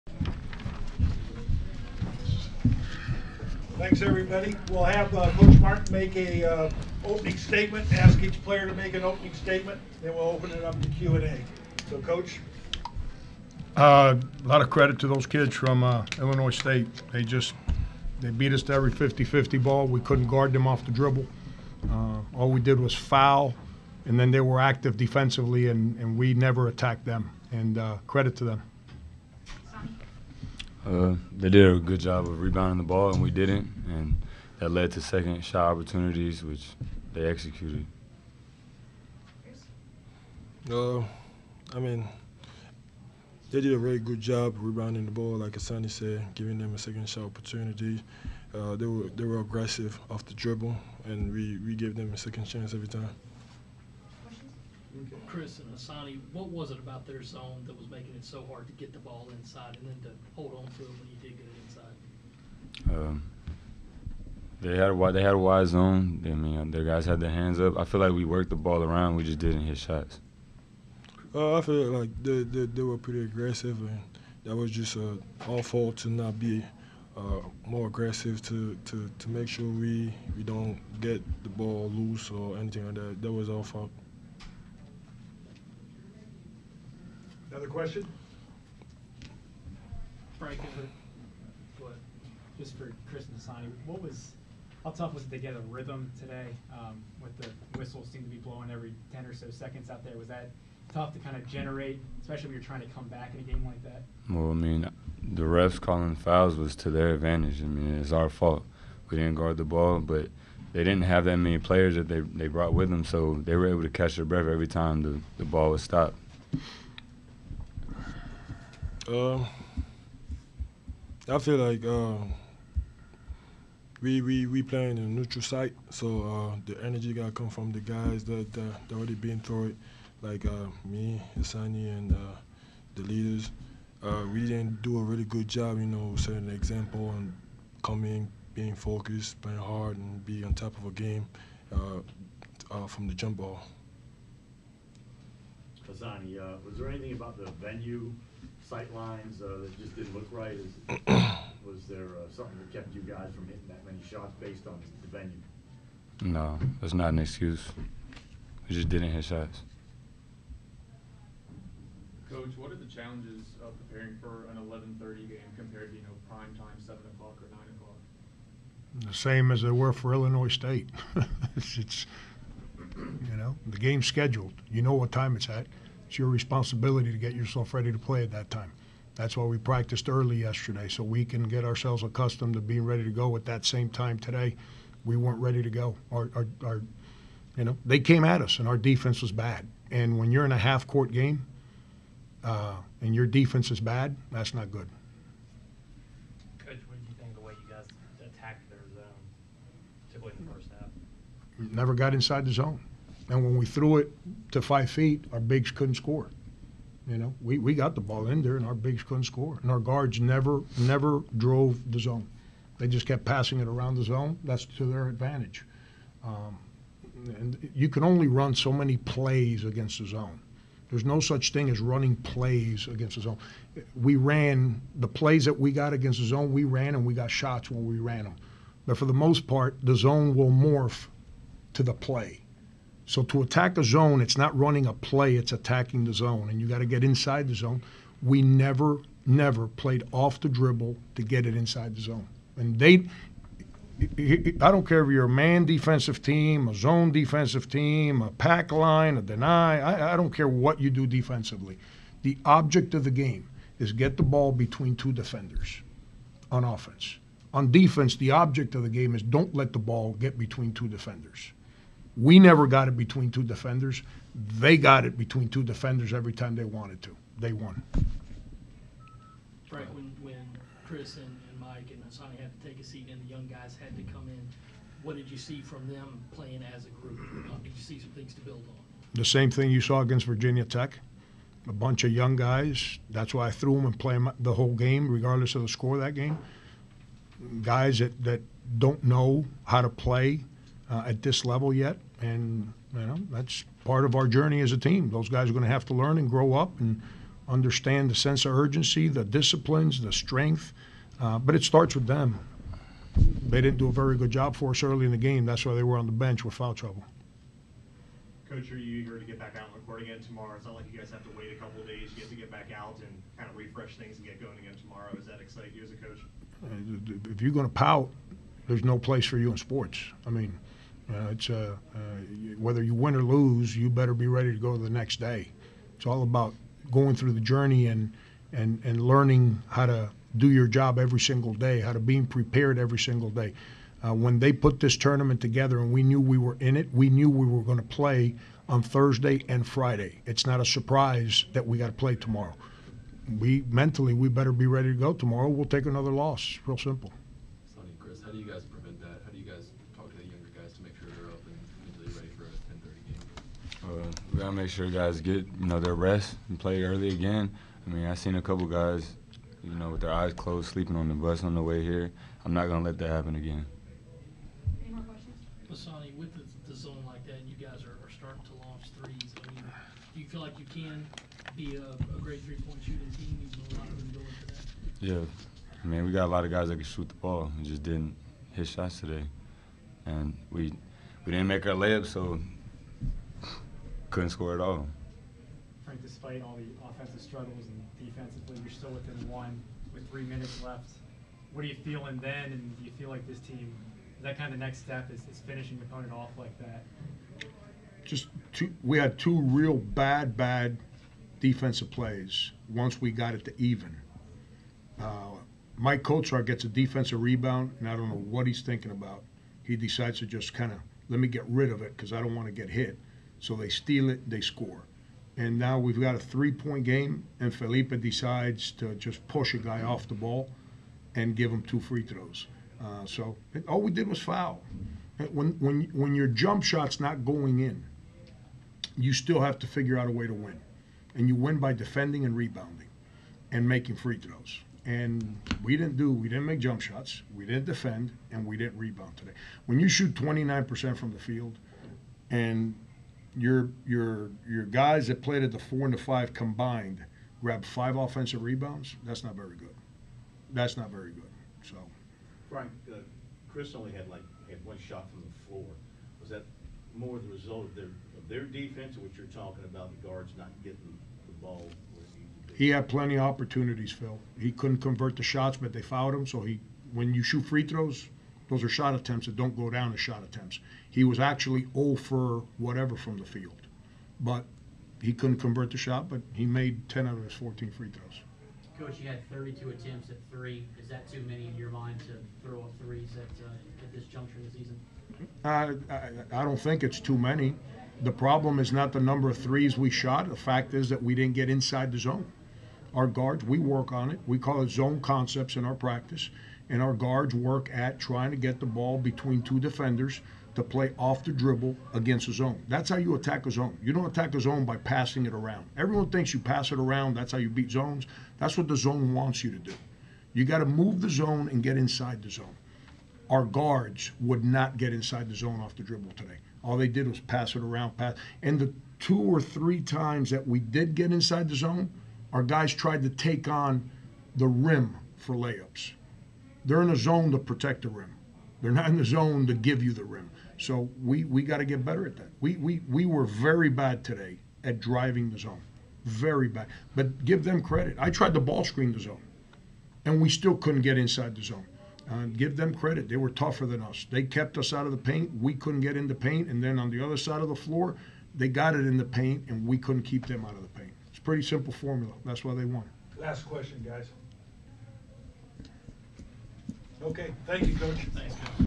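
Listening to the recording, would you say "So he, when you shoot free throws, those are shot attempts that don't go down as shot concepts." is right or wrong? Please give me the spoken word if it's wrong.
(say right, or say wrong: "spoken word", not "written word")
wrong: "attempts", not "concepts".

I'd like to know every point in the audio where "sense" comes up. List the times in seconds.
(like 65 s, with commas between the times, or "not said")
298 s.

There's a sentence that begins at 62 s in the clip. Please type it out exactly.
Um, they had a wide, they had a wide zone.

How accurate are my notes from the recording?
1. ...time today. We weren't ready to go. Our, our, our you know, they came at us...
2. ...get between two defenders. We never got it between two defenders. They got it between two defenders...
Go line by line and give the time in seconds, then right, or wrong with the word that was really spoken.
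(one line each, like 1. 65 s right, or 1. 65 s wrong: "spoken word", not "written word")
1. 183 s right
2. 260 s right.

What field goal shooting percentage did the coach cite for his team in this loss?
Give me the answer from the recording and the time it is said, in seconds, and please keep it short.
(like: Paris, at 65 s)
29%, at 440 s.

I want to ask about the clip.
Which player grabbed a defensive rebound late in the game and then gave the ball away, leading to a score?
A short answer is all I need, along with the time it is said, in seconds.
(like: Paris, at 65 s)
Maik Kotsar, at 405 s.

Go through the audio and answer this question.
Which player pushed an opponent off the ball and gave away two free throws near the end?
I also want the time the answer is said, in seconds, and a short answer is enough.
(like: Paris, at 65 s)
Felipe, at 417 s.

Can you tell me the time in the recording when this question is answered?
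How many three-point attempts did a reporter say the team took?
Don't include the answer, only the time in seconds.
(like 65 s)
479 s.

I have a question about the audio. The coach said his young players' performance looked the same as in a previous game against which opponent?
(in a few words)
Virginia Tech.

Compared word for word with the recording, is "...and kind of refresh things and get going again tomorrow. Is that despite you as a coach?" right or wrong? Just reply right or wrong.
wrong.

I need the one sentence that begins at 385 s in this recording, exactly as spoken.
Frank, despite all the offensive struggles and defensively, you're still within one with three minutes left.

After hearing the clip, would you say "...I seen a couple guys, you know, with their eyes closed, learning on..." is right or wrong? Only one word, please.
wrong.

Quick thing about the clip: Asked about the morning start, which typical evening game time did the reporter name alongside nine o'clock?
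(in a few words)
7 o'clock.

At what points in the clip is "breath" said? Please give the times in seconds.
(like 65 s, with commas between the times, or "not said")
114 s.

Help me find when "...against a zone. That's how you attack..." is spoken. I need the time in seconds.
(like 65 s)
501 s.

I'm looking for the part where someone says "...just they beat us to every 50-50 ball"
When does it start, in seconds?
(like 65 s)
17 s.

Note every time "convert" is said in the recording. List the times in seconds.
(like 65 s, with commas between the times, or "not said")
464 s, 475 s.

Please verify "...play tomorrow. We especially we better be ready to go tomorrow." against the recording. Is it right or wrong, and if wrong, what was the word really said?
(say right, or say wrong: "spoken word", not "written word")
wrong: "mentally", not "especially".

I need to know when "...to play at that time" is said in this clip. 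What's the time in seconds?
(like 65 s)
177 s.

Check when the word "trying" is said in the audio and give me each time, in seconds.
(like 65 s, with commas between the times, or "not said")
102 s, 497 s.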